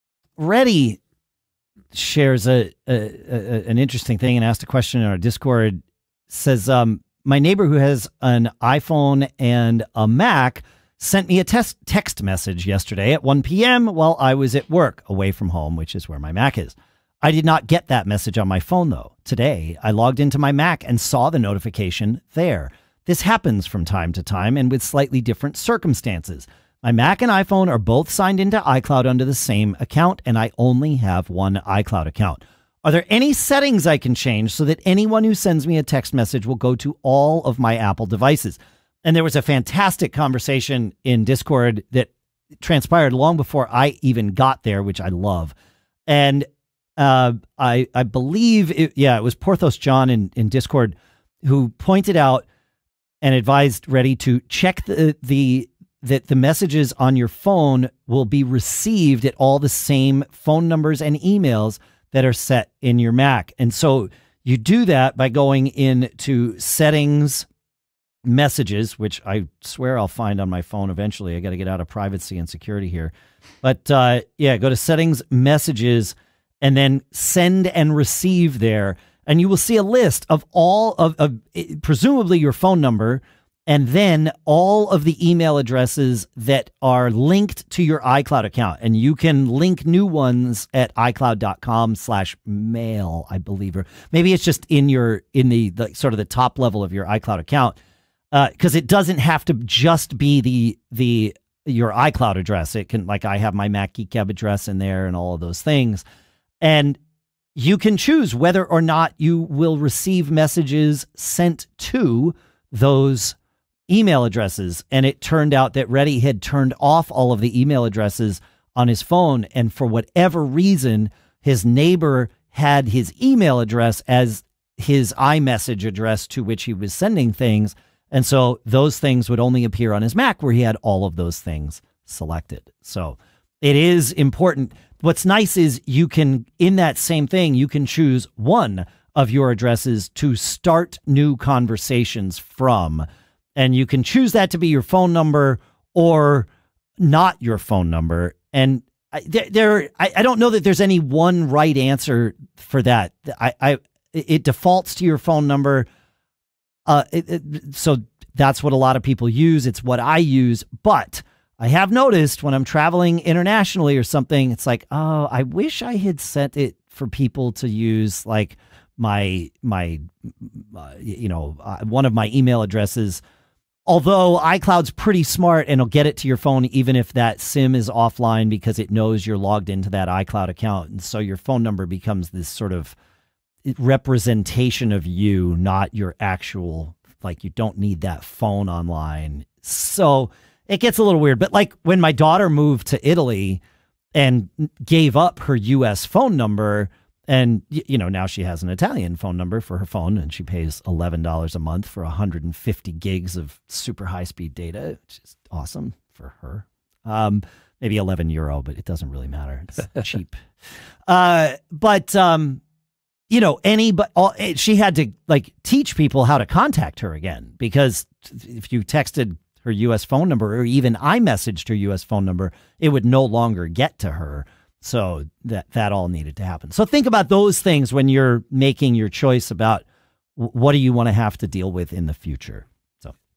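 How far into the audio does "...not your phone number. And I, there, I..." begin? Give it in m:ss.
2:26.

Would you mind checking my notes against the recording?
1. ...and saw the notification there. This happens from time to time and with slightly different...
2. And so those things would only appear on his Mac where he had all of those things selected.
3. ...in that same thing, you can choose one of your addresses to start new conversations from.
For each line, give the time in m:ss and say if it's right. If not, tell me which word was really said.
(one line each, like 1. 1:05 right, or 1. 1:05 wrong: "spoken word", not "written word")
1. 0:20 right
2. 2:08 right
3. 2:16 right.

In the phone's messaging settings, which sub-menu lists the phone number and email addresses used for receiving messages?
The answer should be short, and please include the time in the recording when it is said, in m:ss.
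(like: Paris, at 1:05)
send and receive, at 1:17.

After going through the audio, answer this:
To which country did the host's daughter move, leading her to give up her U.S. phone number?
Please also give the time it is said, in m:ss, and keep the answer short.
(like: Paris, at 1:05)
Italy, at 3:13.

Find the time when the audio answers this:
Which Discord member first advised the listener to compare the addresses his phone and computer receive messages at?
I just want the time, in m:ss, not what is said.
0:49.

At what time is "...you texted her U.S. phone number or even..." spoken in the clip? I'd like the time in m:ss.
3:38.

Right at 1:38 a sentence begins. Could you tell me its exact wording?
because uh, it doesn't have to just be the the your iCloud address.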